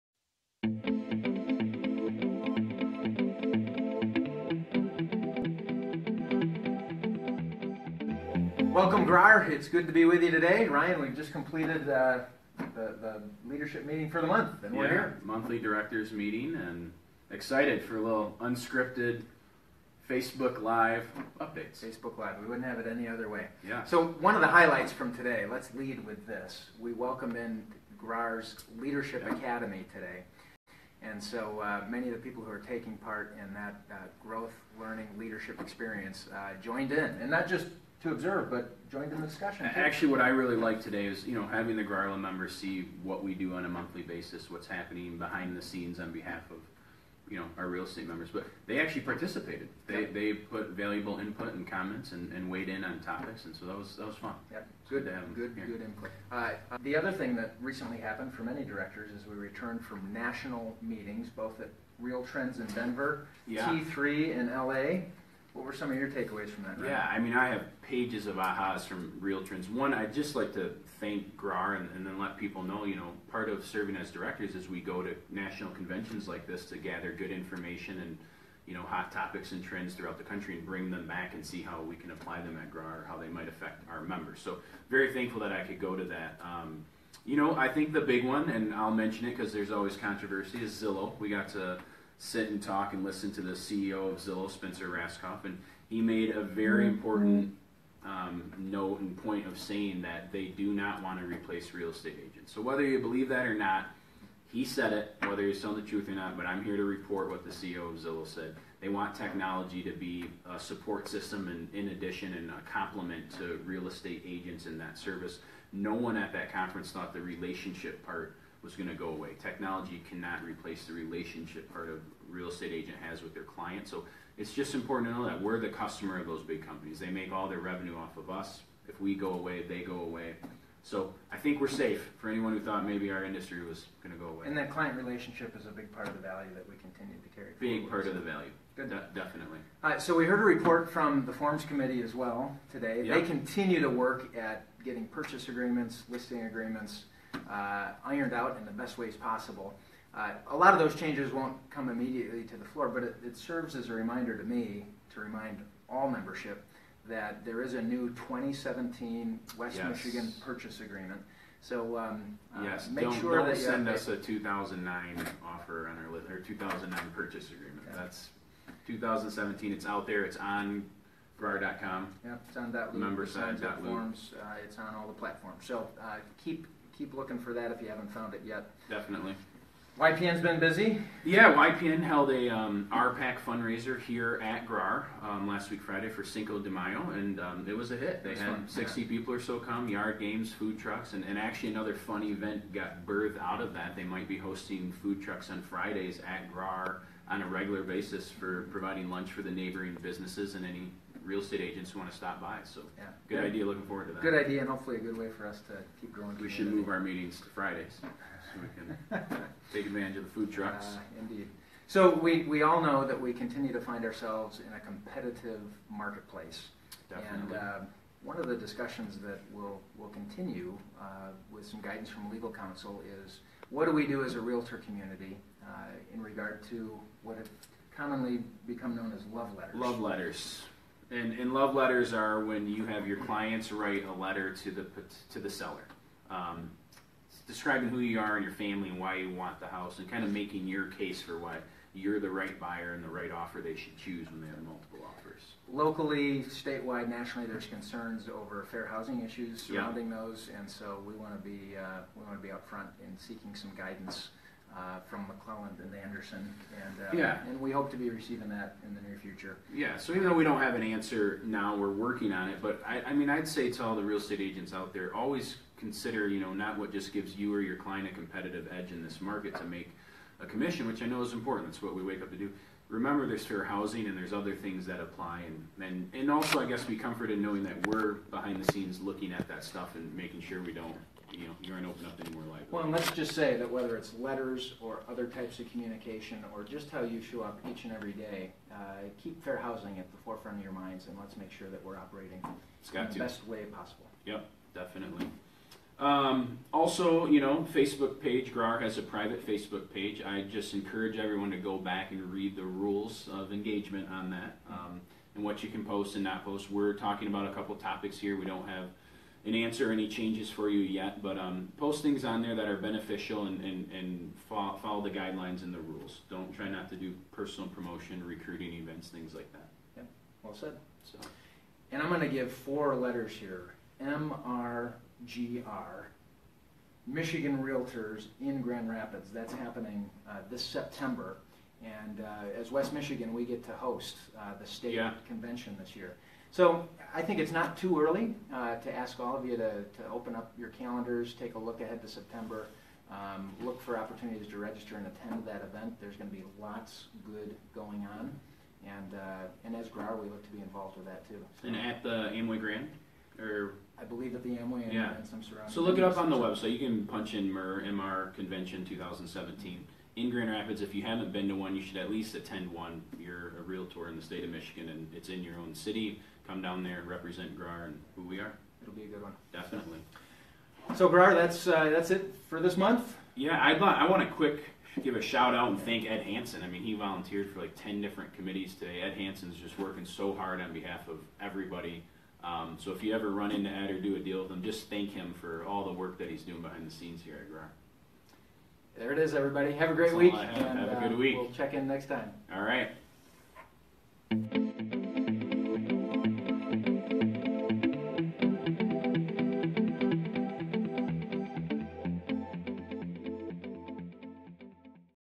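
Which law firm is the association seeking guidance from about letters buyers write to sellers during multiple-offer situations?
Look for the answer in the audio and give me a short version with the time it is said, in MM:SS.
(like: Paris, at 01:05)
McClelland and Anderson, at 04:15.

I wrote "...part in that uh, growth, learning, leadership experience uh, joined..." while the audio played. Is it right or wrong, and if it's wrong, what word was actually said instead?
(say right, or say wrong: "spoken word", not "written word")
right.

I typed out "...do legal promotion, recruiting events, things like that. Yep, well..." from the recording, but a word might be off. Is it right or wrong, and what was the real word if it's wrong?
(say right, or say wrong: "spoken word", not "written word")
wrong: "personal", not "legal".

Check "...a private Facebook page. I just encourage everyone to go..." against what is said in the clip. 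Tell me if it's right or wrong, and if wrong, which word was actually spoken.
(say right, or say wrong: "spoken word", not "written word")
right.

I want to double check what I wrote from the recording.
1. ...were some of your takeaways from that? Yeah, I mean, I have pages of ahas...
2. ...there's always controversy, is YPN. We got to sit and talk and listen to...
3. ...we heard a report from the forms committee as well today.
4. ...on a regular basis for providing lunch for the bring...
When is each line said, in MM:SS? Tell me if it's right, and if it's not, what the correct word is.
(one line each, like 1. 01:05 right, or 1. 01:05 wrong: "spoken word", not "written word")
1. 01:05 right
2. 01:29 wrong: "Zillow", not "YPN"
3. 02:20 right
4. 03:17 wrong: "neighboring", not "bring".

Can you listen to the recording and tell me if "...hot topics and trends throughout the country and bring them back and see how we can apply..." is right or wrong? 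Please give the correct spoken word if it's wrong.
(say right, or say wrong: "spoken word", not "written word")
right.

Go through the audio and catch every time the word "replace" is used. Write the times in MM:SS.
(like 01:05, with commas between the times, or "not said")
01:41, 02:00.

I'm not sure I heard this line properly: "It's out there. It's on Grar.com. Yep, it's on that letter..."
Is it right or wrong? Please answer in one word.
wrong.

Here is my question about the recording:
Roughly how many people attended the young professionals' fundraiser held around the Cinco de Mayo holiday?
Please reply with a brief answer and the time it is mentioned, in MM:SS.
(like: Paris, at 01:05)
60, at 03:08.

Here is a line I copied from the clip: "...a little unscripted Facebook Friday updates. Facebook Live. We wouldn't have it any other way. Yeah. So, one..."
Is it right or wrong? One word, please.
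wrong.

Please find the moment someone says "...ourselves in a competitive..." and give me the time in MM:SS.
03:34.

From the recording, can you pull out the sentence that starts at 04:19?
Yeah, so even though we don't have an answer now, we're working on it.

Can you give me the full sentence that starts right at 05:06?
We're talking about a couple topics here.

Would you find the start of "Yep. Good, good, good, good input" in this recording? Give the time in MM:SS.
00:54.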